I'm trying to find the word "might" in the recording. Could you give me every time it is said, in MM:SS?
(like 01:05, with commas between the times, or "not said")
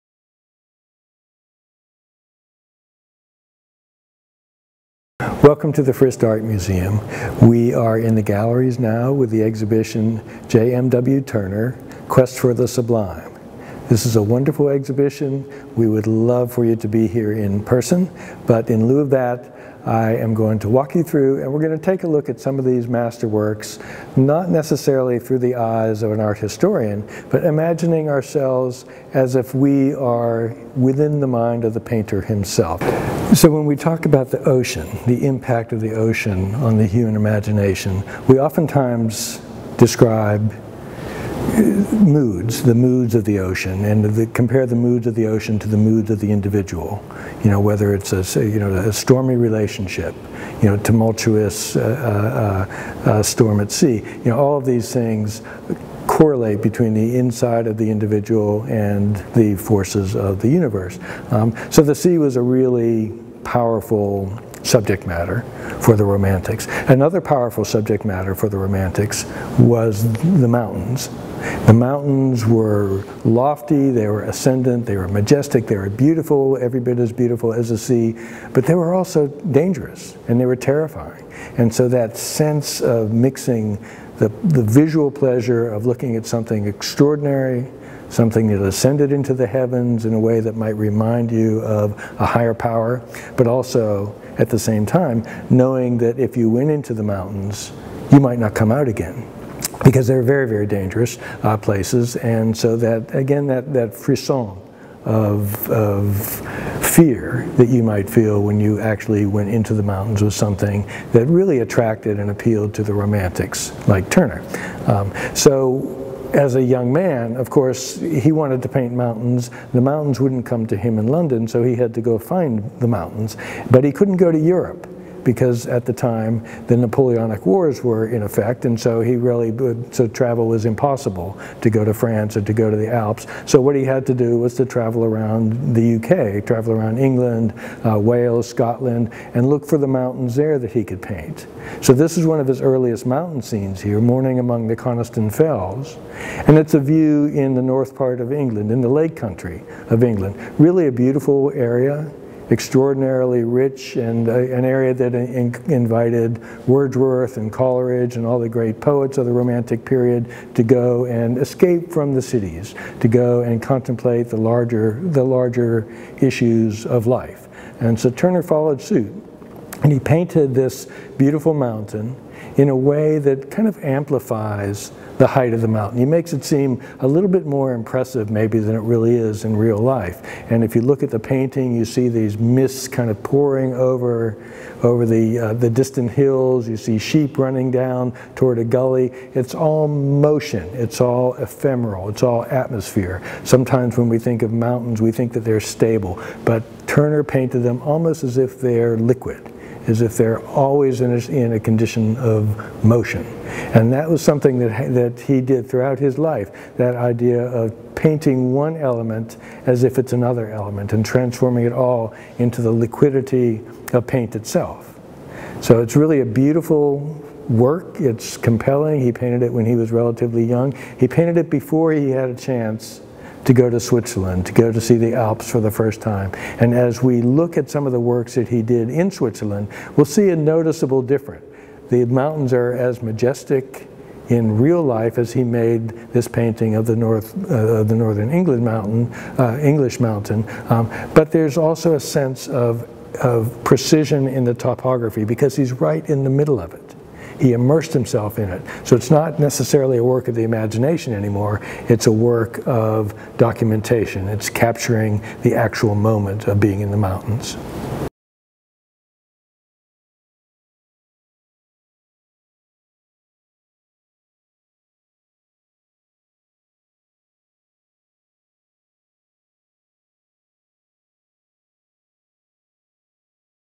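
01:30, 01:38, 01:47.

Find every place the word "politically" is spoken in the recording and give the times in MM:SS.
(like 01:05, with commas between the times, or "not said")
not said.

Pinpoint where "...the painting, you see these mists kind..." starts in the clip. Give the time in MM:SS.
03:01.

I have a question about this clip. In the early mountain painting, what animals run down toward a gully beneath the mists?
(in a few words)
Sheep.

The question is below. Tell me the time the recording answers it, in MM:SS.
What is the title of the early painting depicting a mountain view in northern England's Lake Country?
02:23.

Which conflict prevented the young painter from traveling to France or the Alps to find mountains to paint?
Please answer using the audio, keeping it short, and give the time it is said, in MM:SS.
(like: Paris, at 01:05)
Napoleonic Wars, at 02:06.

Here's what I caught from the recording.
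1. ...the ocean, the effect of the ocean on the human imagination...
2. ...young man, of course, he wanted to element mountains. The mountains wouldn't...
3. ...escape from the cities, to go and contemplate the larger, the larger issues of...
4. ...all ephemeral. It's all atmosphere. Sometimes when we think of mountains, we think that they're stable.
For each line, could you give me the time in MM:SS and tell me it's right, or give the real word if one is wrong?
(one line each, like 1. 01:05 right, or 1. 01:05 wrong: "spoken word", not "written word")
1. 00:34 wrong: "impact", not "effect"
2. 01:56 wrong: "paint", not "element"
3. 02:41 right
4. 03:11 right.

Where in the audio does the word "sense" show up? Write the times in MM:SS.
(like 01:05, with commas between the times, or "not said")
01:22, 04:01.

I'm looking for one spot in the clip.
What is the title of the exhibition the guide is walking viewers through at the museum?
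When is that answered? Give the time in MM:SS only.
00:10.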